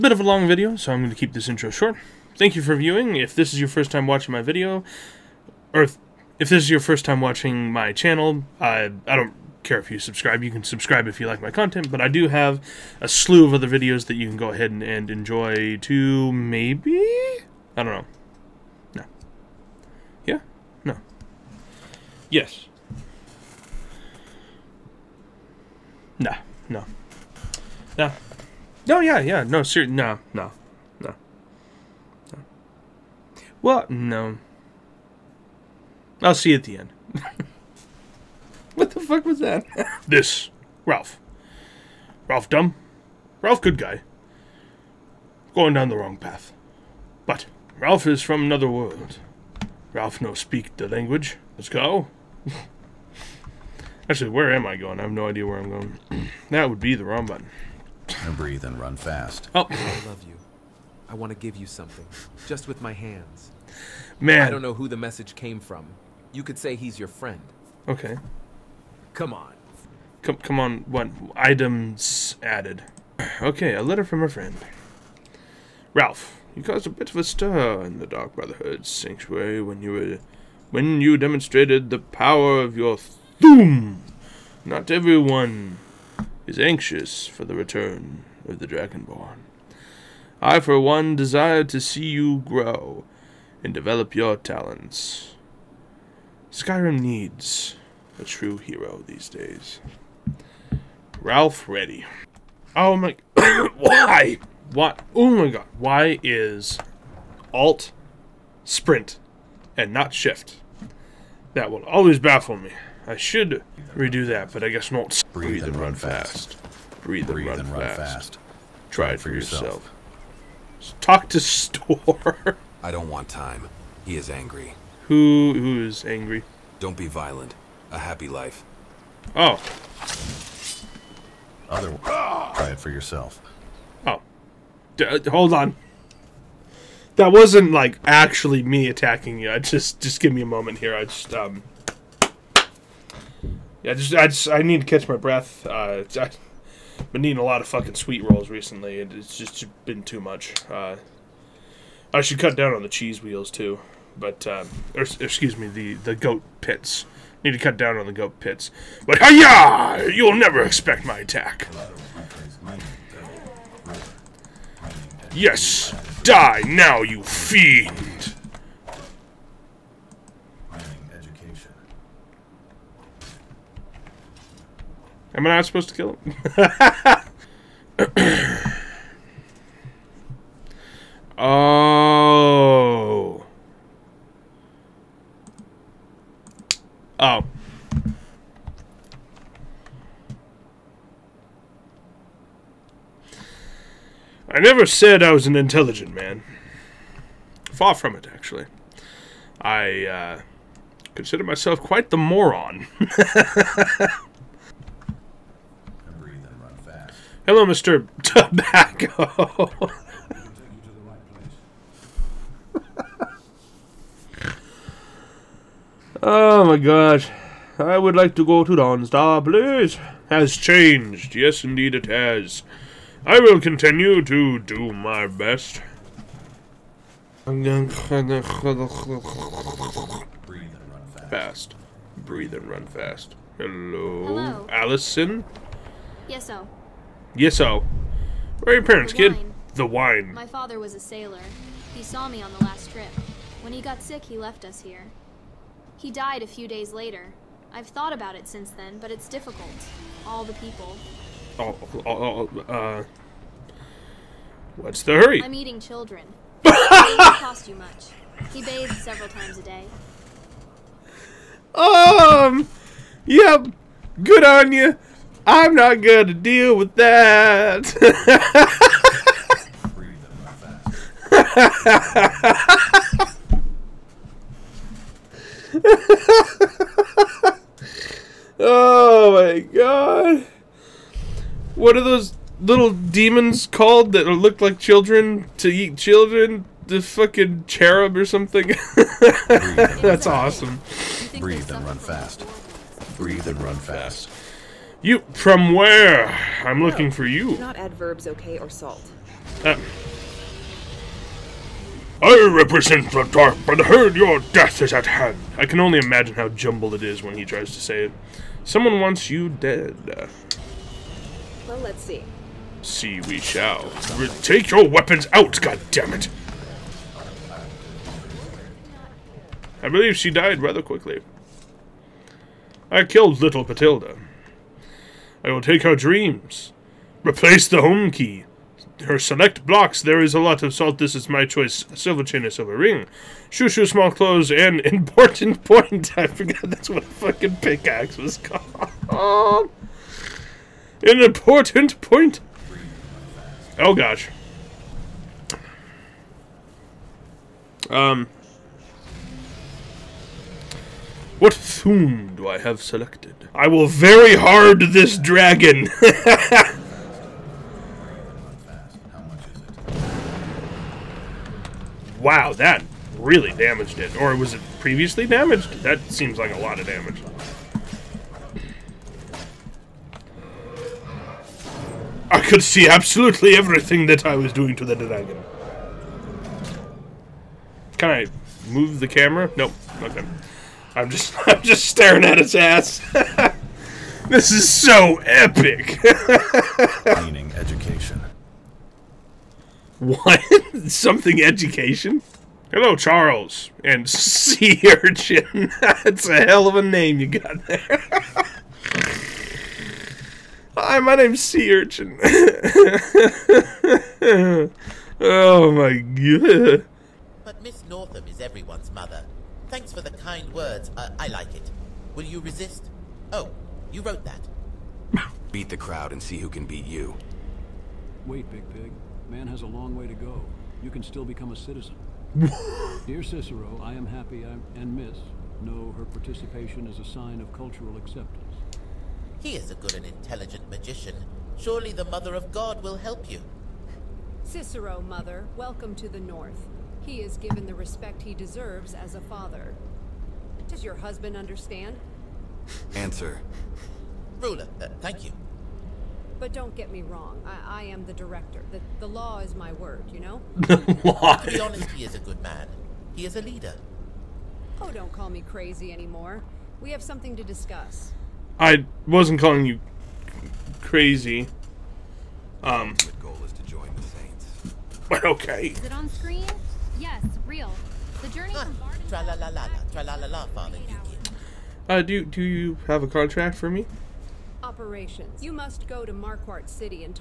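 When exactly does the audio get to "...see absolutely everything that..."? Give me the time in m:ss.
6:12.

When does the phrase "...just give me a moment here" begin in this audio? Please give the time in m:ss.
2:20.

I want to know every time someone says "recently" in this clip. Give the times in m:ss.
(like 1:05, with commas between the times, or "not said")
2:28.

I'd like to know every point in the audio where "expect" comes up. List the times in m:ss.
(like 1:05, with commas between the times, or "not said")
2:40.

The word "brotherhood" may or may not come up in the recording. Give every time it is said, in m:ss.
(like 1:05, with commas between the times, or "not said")
1:18, 5:03.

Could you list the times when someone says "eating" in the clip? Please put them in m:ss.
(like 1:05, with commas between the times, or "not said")
2:27, 4:15.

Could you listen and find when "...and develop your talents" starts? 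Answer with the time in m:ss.
1:33.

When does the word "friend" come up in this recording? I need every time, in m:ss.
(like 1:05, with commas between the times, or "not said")
1:07, 1:14.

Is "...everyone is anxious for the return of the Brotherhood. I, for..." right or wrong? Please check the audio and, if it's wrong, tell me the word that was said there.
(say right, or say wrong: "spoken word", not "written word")
wrong: "Dragonborn", not "Brotherhood".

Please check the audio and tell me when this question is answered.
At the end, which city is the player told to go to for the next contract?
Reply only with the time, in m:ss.
7:56.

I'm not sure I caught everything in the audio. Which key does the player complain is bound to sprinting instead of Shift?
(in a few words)
Alt.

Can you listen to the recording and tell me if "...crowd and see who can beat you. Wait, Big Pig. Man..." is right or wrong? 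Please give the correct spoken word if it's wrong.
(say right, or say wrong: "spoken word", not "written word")
right.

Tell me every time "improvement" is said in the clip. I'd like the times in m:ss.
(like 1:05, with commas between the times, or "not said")
not said.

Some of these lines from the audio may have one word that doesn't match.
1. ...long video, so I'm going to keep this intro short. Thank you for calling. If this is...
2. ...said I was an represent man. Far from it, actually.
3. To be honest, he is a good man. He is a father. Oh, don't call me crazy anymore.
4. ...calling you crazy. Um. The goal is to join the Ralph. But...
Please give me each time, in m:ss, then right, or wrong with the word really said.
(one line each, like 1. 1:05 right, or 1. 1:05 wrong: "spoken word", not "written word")
1. 0:00 wrong: "viewing", not "calling"
2. 3:14 wrong: "intelligent", not "represent"
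3. 7:30 wrong: "leader", not "father"
4. 7:39 wrong: "Saints", not "Ralph".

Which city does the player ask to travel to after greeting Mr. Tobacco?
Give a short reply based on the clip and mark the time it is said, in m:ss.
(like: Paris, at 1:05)
Dawnstar, at 3:38.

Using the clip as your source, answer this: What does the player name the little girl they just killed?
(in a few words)
Patilda.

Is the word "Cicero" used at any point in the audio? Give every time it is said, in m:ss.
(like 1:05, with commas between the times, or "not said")
7:03, 7:14.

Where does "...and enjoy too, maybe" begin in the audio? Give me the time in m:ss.
0:14.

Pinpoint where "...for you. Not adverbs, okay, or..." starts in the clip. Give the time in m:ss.
4:57.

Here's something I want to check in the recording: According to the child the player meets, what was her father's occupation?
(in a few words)
Sailor.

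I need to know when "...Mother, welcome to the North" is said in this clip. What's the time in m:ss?
7:15.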